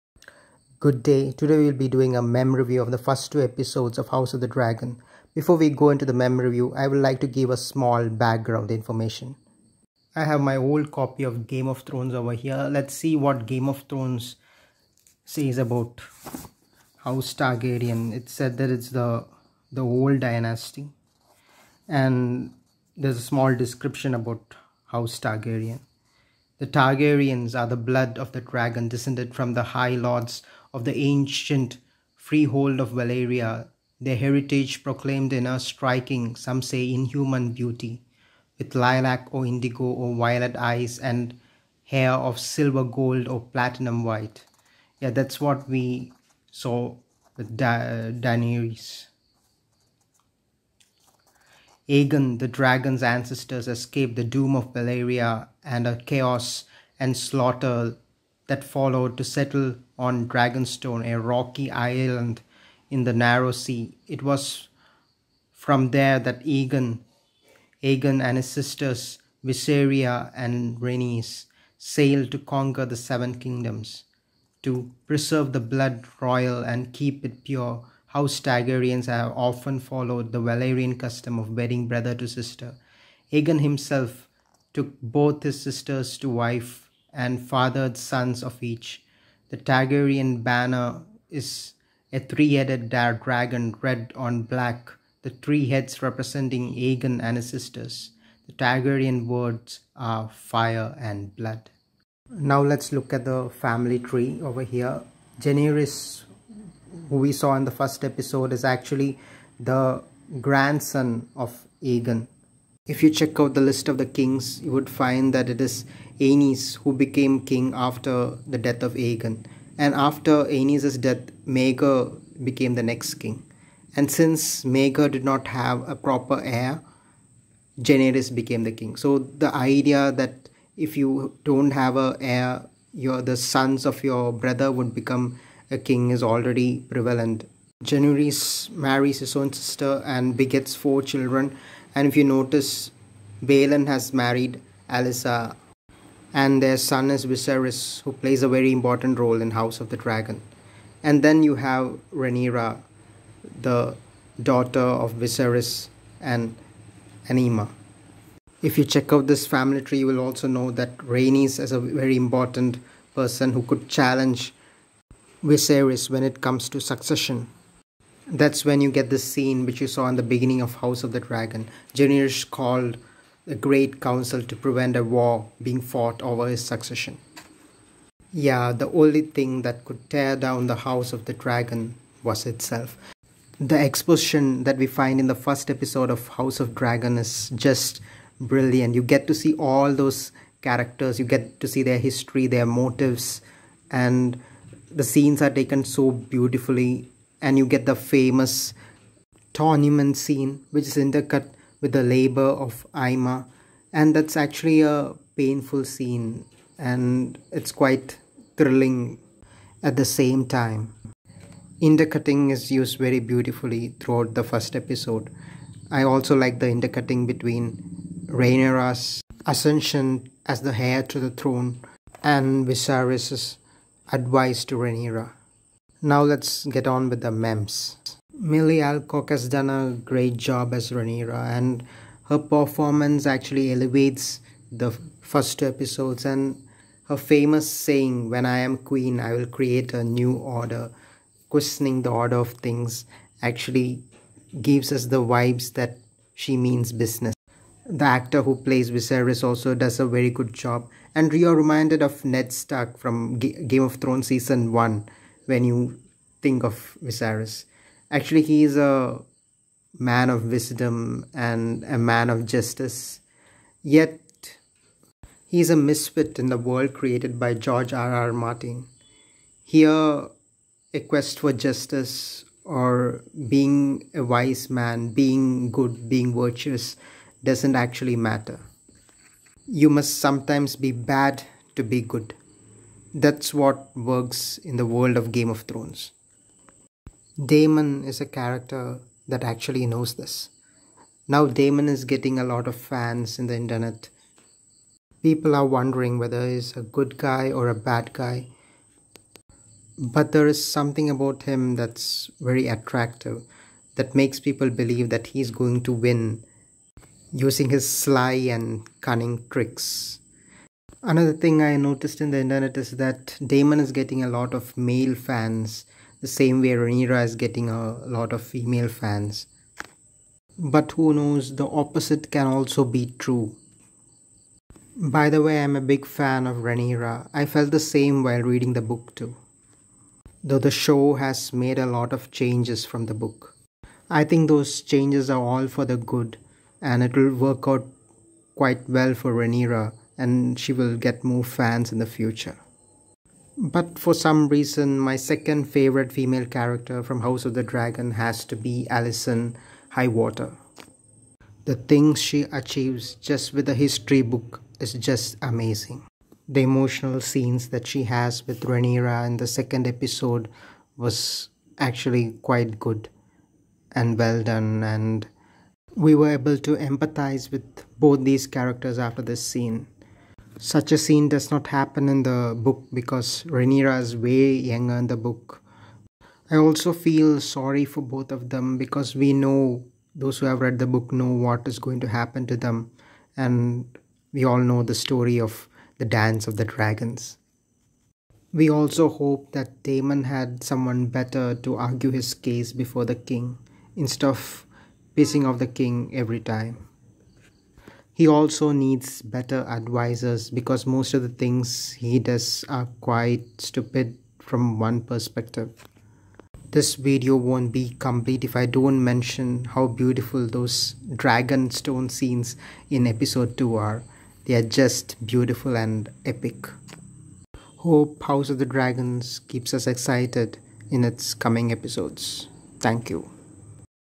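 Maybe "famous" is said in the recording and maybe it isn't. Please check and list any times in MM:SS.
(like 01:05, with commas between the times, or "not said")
03:17, 03:57.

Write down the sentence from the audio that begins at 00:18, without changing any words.
It said that it's the the old dynasty and there's a small description about House Targaryen.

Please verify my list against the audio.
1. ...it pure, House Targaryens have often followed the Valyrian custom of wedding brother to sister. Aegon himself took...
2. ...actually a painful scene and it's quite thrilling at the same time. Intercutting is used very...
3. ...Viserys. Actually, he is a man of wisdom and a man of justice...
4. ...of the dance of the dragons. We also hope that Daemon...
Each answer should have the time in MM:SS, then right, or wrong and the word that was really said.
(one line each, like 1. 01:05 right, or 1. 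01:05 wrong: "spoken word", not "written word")
1. 01:17 right
2. 03:24 right
3. 04:17 right
4. 06:25 right.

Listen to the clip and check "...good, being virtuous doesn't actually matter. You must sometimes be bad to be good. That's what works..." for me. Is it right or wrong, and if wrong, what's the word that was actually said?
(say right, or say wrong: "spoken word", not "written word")
right.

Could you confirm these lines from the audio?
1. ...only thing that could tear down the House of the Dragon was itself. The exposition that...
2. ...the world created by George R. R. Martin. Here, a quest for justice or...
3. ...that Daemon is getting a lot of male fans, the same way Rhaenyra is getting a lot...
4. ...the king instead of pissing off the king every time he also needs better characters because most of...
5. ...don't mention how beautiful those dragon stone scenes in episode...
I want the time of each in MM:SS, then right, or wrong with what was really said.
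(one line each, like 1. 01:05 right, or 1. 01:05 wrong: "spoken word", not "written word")
1. 02:58 right
2. 04:26 right
3. 05:12 right
4. 06:33 wrong: "advisors", not "characters"
5. 06:48 right.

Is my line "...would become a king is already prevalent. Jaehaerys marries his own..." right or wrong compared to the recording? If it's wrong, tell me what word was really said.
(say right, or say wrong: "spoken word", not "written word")
right.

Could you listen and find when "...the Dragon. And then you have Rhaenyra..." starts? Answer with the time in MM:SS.
02:29.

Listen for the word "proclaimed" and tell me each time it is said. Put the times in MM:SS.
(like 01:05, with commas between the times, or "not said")
00:34.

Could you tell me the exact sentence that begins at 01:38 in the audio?
The Targaryen words are fire and blood.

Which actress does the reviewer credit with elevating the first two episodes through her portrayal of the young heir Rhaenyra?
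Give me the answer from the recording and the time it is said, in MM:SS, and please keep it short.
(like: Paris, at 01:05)
Millie Alcock, at 03:48.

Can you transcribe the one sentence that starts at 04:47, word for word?
Daemon is a character that actually knows this.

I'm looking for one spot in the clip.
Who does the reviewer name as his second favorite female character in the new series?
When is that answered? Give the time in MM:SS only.
05:48.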